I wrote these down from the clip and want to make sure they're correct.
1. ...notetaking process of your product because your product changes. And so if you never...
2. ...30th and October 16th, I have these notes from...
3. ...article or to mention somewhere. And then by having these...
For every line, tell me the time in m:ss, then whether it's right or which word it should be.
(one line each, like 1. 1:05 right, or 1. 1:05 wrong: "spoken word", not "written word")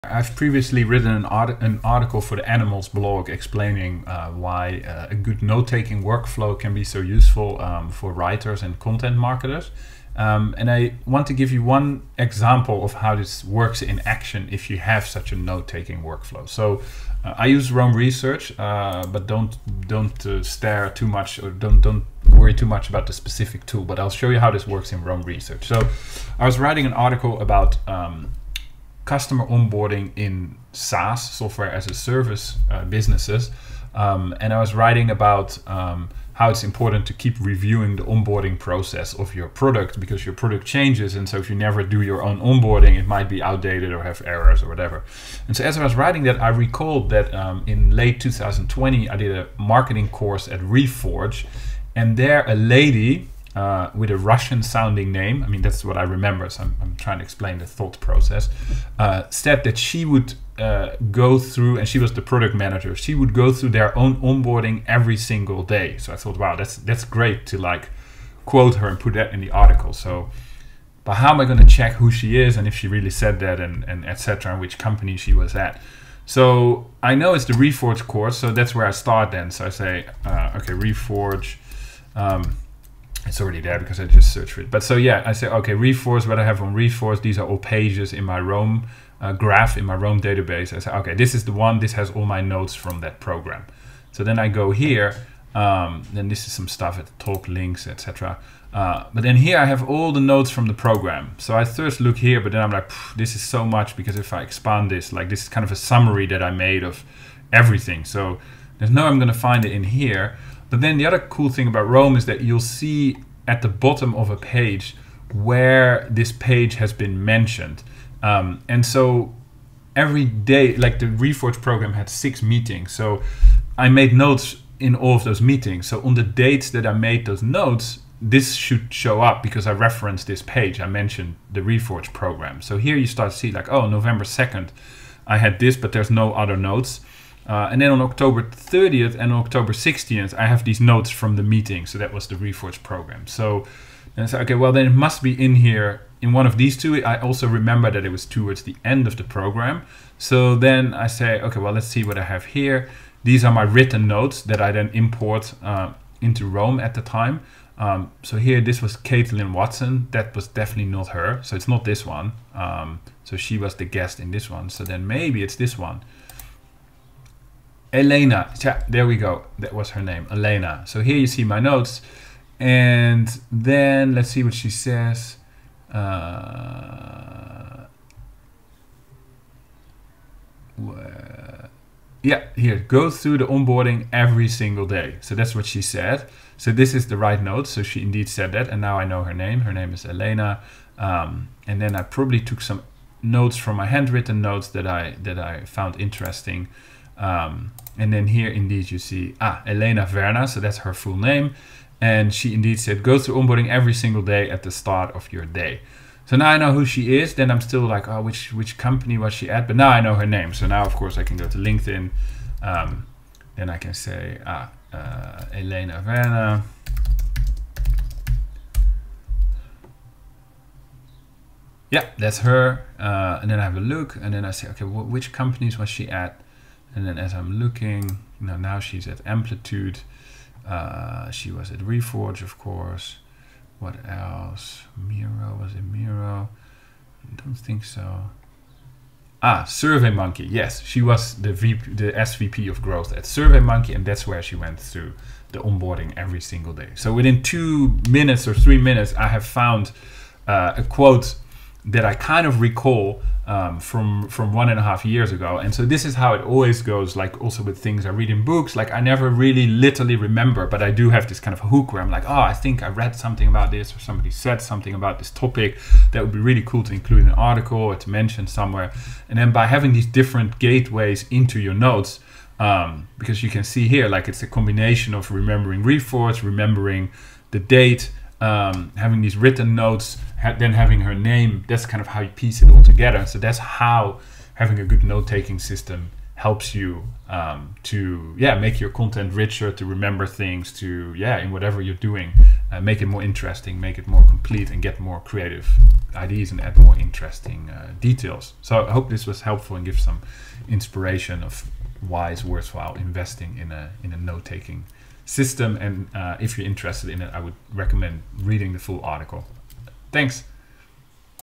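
1. 0:38 wrong: "onboarding", not "notetaking"
2. 2:18 right
3. 4:27 right.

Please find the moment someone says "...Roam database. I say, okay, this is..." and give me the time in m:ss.
1:29.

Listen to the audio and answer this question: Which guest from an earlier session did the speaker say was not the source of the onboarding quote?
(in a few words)
Caitlin Watson.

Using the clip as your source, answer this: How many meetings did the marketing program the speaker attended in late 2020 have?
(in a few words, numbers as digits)
6.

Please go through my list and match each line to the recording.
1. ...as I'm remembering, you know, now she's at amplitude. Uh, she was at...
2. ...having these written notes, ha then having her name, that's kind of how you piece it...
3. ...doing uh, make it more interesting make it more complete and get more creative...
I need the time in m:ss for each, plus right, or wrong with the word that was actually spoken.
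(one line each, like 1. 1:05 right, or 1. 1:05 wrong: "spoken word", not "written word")
1. 3:47 wrong: "looking", not "remembering"
2. 4:38 right
3. 4:52 right.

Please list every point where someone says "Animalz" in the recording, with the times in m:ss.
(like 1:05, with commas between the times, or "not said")
0:02.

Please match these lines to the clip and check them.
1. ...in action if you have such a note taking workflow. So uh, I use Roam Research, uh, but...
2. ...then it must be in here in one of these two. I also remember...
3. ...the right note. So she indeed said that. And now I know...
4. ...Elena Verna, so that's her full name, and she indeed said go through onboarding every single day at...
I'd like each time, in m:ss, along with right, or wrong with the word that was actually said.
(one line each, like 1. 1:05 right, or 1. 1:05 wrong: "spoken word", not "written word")
1. 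0:13 right
2. 2:24 right
3. 3:07 right
4. 3:19 right.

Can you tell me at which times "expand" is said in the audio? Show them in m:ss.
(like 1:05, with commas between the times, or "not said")
1:44.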